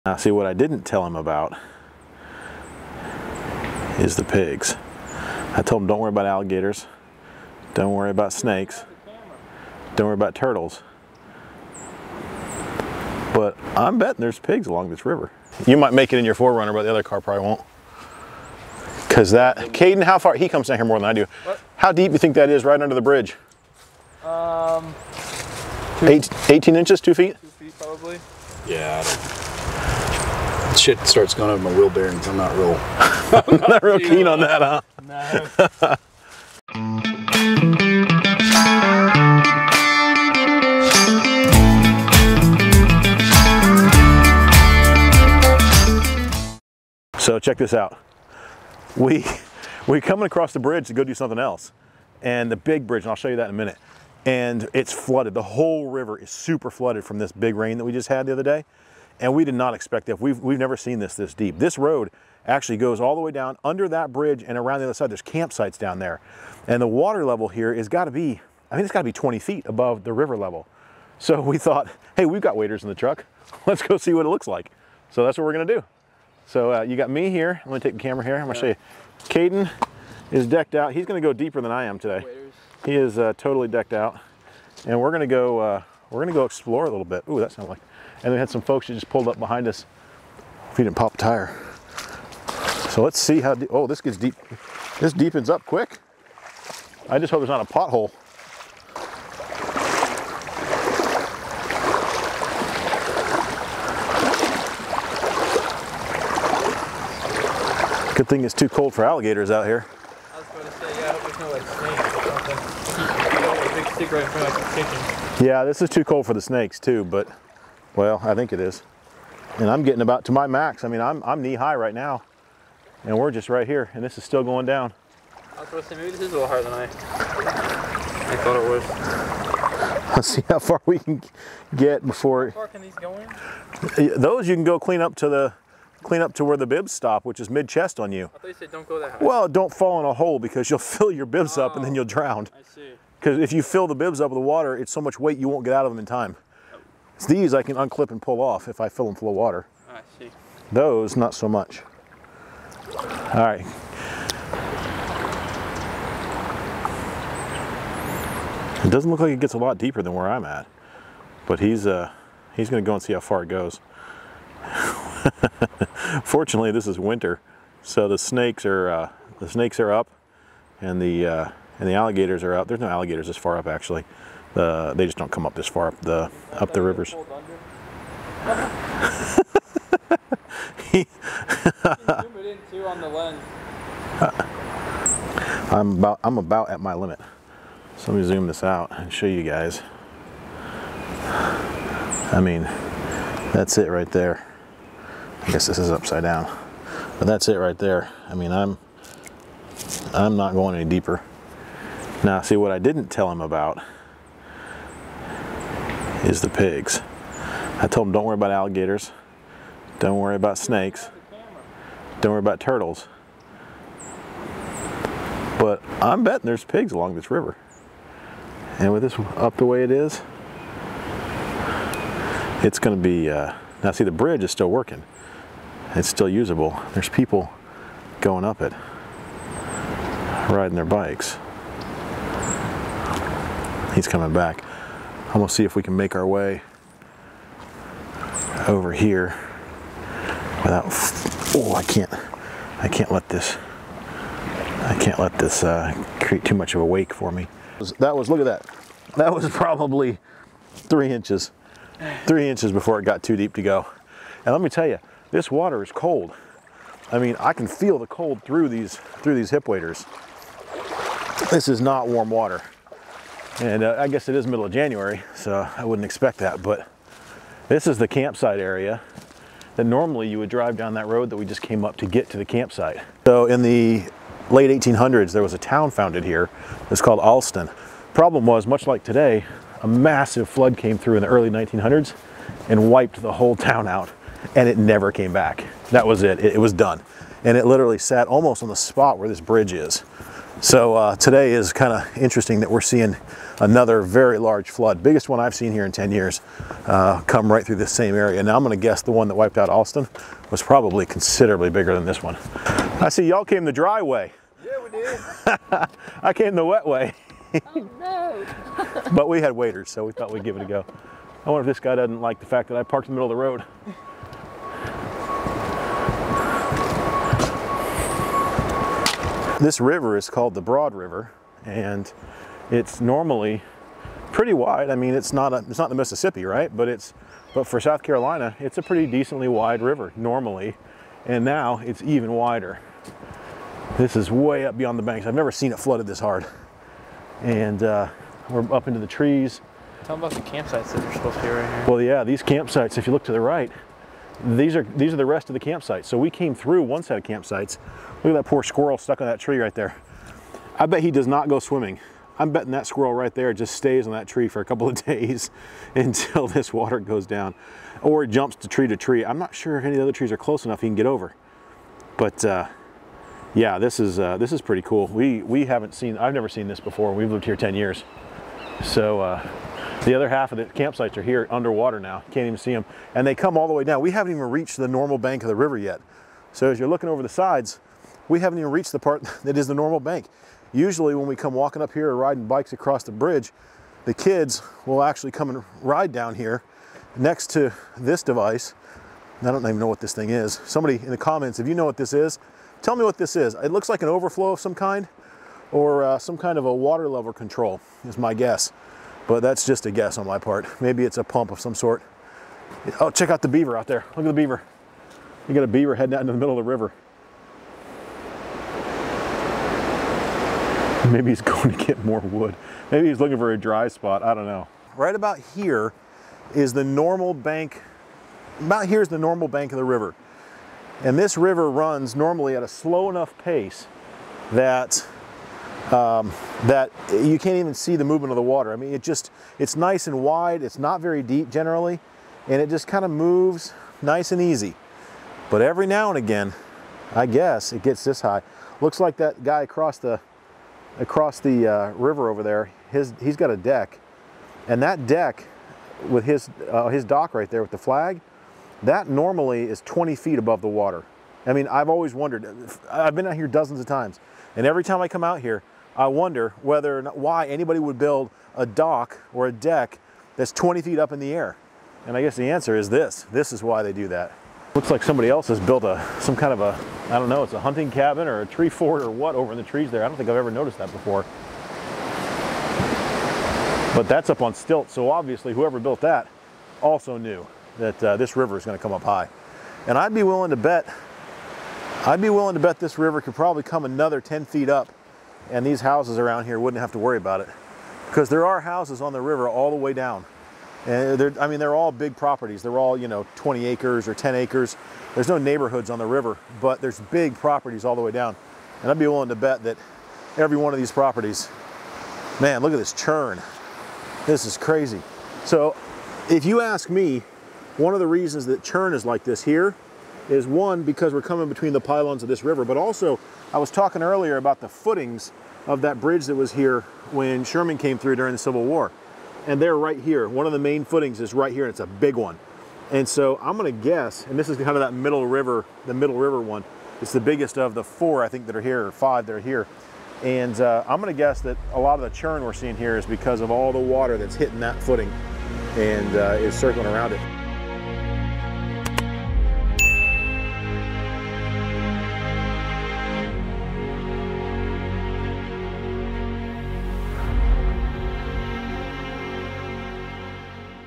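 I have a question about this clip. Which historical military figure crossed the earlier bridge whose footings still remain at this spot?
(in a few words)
Sherman.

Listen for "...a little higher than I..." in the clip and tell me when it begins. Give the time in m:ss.
2:06.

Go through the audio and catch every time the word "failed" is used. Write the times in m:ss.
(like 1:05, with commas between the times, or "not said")
not said.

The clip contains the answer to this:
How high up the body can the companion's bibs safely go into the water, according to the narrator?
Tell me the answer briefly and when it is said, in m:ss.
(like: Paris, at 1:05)
mid chest, at 2:17.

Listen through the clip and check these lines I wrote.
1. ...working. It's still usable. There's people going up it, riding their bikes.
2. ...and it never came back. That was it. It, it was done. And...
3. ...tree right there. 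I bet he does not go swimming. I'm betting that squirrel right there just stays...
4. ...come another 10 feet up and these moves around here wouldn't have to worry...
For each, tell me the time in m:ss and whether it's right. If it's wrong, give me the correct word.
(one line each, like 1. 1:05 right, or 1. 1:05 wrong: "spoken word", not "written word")
1. 3:44 right
2. 4:44 right
3. 5:49 right
4. 8:03 wrong: "houses", not "moves".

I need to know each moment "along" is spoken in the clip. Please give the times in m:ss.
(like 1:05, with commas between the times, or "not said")
0:14, 3:36.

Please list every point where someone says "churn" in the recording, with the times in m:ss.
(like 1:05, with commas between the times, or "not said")
8:22, 8:28, 8:52.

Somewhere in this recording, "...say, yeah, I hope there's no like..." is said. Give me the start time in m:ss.
1:50.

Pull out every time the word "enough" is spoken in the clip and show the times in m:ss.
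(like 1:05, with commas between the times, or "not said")
6:00, 7:03.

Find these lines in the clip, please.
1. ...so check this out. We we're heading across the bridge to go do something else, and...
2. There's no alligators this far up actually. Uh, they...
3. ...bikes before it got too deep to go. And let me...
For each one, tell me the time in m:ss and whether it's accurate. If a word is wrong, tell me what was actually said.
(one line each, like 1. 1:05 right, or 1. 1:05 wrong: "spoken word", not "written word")
1. 0:47 wrong: "coming", not "heading"
2. 2:52 right
3. 4:12 wrong: "inches", not "bikes".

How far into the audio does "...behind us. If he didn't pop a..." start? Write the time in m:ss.
1:29.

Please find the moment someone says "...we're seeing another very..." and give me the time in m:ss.
4:52.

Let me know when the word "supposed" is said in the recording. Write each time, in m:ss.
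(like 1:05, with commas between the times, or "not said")
5:41.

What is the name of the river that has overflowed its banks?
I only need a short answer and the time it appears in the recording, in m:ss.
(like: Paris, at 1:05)
Broad River, at 5:20.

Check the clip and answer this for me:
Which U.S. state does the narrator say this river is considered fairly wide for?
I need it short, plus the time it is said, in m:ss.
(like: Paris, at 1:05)
South Carolina, at 5:27.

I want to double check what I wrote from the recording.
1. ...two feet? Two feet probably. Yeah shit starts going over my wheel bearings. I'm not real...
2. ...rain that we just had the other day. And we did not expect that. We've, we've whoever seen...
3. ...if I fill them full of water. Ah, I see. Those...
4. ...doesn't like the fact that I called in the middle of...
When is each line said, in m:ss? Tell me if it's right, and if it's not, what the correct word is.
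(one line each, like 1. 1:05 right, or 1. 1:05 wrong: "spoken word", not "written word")
1. 0:27 right
2. 0:57 wrong: "never", not "whoever"
3. 2:28 right
4. 5:11 wrong: "parked", not "called".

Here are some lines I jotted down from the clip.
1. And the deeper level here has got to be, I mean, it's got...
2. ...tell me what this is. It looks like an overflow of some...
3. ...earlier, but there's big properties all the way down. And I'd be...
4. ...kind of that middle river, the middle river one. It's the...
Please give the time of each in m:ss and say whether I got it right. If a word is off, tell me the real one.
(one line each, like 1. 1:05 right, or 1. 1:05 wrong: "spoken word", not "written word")
1. 1:06 wrong: "water", not "deeper"
2. 6:32 right
3. 8:16 wrong: "river", not "earlier"
4. 8:44 right.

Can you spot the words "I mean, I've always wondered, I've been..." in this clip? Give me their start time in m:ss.
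7:31.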